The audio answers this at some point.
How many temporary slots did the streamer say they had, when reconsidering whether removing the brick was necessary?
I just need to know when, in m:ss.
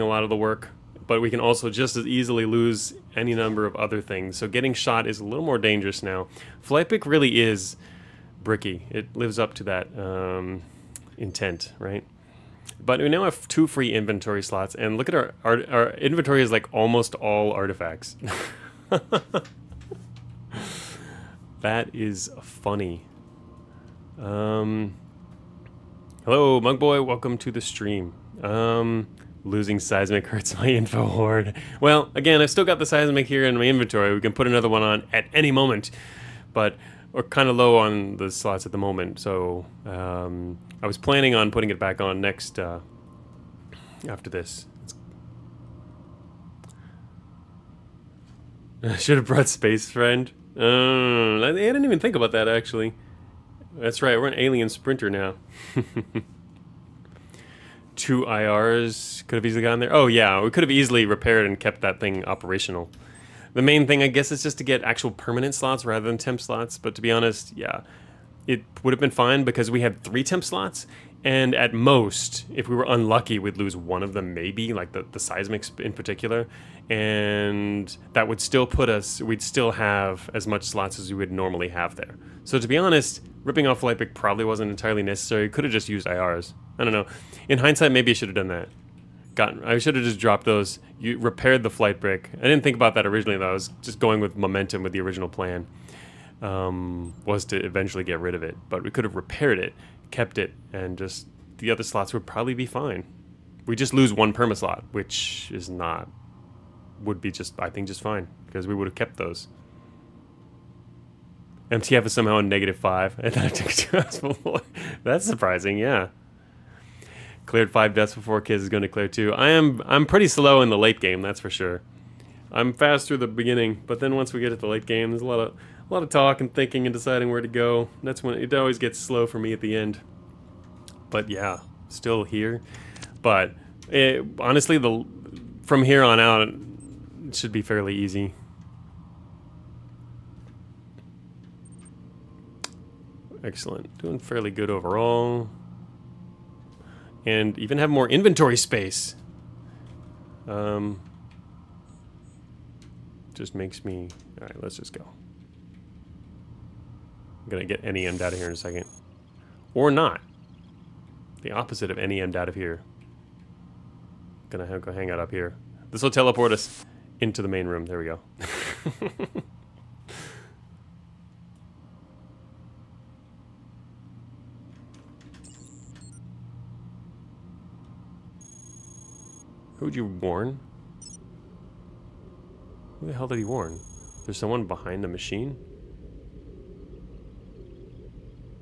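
1:10.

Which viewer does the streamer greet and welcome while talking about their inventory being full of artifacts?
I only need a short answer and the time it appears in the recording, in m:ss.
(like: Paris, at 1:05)
Mugboy, at 0:26.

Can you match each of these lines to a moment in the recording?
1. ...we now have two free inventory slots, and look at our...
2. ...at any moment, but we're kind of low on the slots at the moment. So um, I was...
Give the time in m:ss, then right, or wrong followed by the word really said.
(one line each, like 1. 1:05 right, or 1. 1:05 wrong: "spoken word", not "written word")
1. 0:13 right
2. 0:35 right.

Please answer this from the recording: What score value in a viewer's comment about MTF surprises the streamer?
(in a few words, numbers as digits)
-5.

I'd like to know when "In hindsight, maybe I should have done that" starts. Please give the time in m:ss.
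1:27.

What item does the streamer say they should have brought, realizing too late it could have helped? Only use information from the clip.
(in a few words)
space friend.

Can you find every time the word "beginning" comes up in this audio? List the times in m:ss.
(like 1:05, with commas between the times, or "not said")
2:03.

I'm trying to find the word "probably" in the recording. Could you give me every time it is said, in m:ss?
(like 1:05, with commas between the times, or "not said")
1:24, 1:42.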